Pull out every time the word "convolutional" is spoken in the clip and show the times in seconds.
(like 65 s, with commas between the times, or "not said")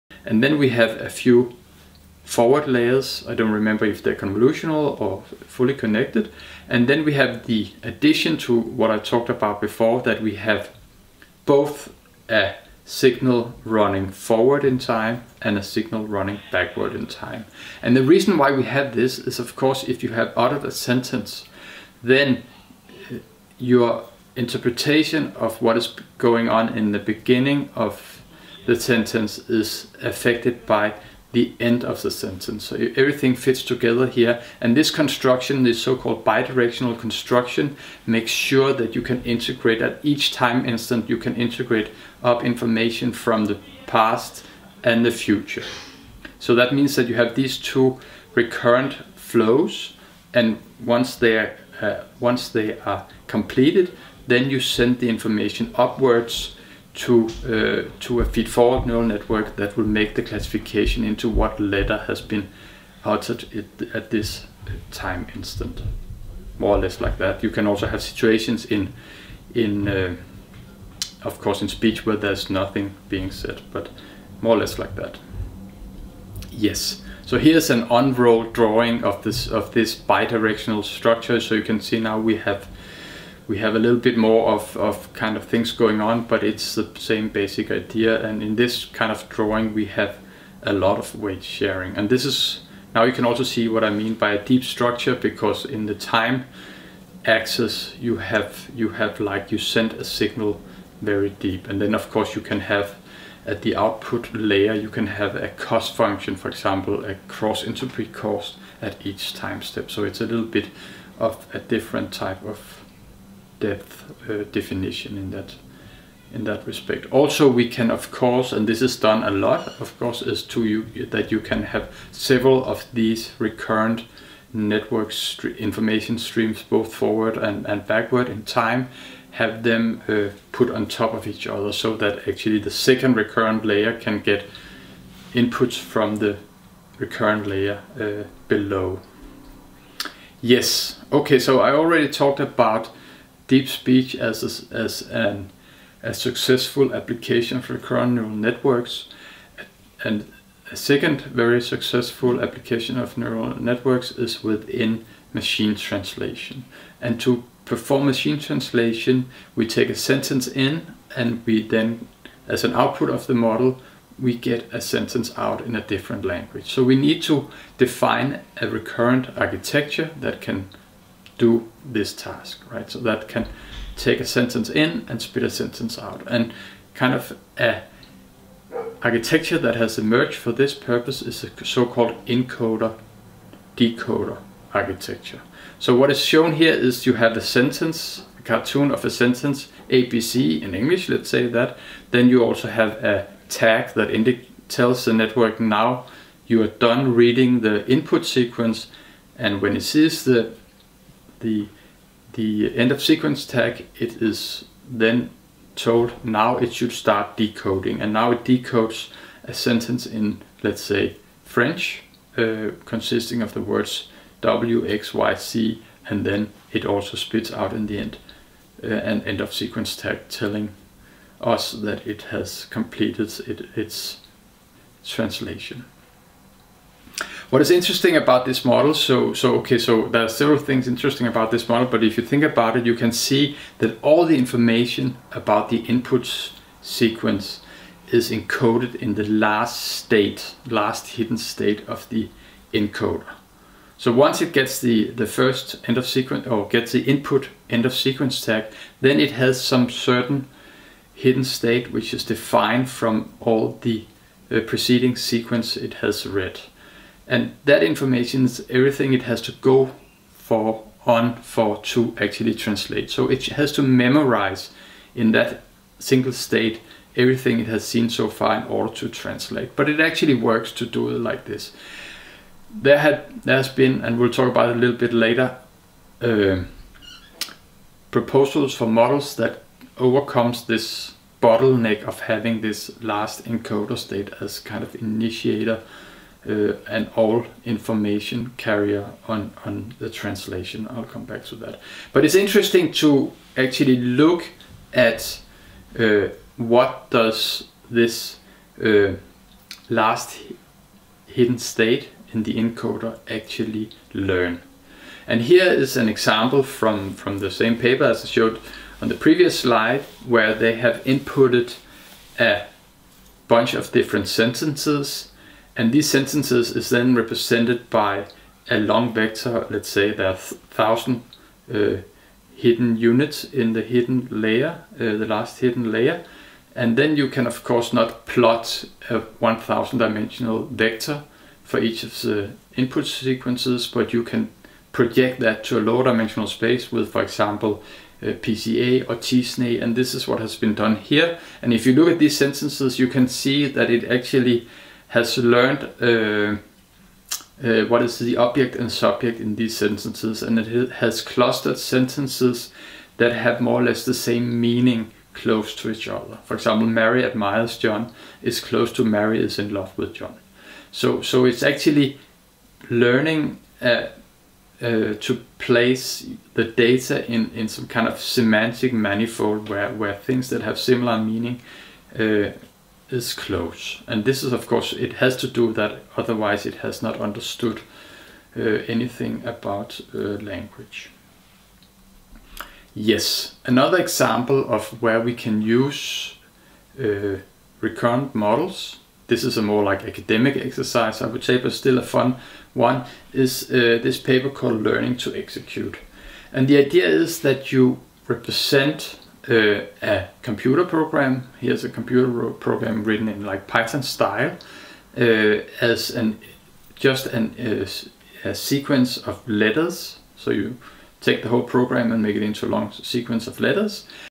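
4 s.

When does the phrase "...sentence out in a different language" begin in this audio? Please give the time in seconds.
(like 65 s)
164 s.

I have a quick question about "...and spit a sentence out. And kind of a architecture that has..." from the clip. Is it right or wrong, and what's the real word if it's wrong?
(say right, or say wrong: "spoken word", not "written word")
right.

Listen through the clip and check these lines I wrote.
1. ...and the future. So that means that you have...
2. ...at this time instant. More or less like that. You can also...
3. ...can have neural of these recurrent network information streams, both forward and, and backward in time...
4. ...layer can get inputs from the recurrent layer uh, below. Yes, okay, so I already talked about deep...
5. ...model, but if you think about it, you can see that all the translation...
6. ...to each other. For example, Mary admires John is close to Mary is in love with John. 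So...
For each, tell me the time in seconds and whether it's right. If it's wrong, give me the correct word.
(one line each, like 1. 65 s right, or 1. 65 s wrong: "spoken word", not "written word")
1. 44 s right
2. 63 s right
3. 121 s wrong: "several", not "neural"
4. 133 s right
5. 231 s wrong: "information", not "translation"
6. 355 s right.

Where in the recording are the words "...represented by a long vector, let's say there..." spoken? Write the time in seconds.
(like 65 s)
317 s.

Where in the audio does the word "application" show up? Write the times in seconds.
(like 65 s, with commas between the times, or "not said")
146 s, 152 s.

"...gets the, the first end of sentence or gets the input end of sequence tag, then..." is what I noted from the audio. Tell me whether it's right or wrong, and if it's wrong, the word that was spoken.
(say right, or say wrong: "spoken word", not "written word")
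wrong: "sequence", not "sentence".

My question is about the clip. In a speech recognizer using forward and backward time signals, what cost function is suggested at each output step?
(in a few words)
cross entropy.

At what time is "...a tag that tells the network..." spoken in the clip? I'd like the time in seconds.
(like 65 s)
193 s.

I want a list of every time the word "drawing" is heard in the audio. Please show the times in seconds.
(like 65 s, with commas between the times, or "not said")
78 s, 89 s.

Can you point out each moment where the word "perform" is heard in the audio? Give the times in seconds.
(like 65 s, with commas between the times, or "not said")
157 s.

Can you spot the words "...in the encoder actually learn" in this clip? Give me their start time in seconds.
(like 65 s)
302 s.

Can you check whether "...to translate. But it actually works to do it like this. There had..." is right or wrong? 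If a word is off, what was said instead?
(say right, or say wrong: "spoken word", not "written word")
right.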